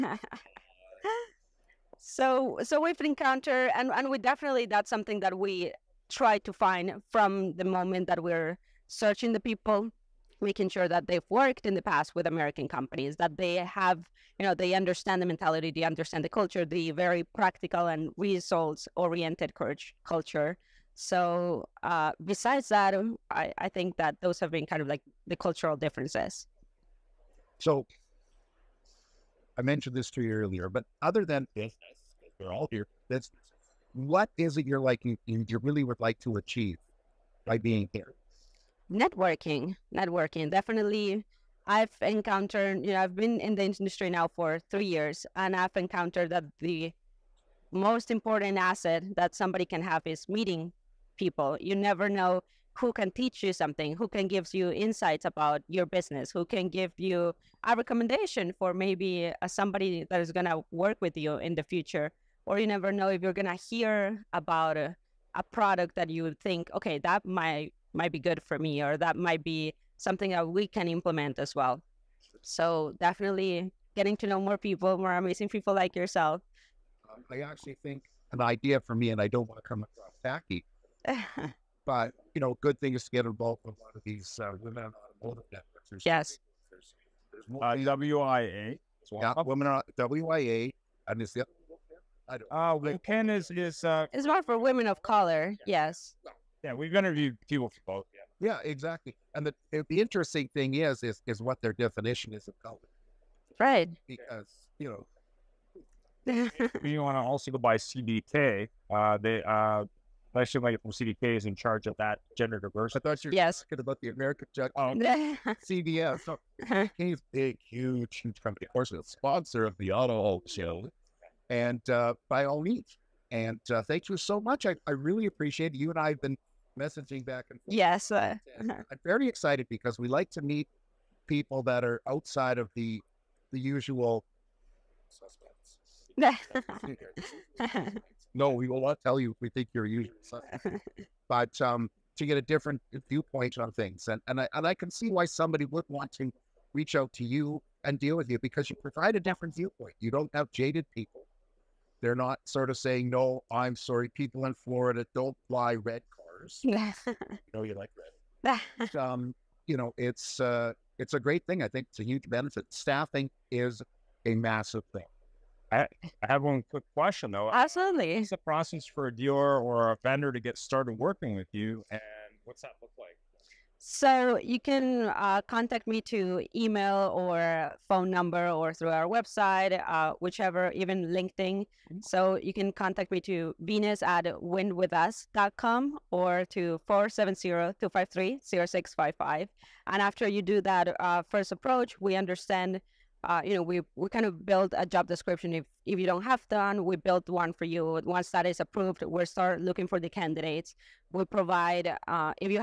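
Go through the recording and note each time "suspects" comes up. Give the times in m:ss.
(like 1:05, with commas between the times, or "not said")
2:15.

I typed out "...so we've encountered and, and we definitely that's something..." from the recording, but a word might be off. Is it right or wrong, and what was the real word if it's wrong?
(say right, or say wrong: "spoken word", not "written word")
right.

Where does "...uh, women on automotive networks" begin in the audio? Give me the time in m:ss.
1:24.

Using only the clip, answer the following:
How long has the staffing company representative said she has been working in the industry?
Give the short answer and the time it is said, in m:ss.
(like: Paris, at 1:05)
3 years, at 0:44.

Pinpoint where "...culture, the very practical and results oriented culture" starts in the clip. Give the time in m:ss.
0:16.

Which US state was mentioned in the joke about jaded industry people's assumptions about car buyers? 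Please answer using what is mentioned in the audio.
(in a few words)
Florida.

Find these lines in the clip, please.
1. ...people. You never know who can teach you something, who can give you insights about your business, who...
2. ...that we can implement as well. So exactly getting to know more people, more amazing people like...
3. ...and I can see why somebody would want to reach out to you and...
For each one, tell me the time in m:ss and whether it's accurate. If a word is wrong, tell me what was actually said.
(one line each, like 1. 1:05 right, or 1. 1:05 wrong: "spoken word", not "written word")
1. 0:51 right
2. 1:10 wrong: "definitely", not "exactly"
3. 2:24 right.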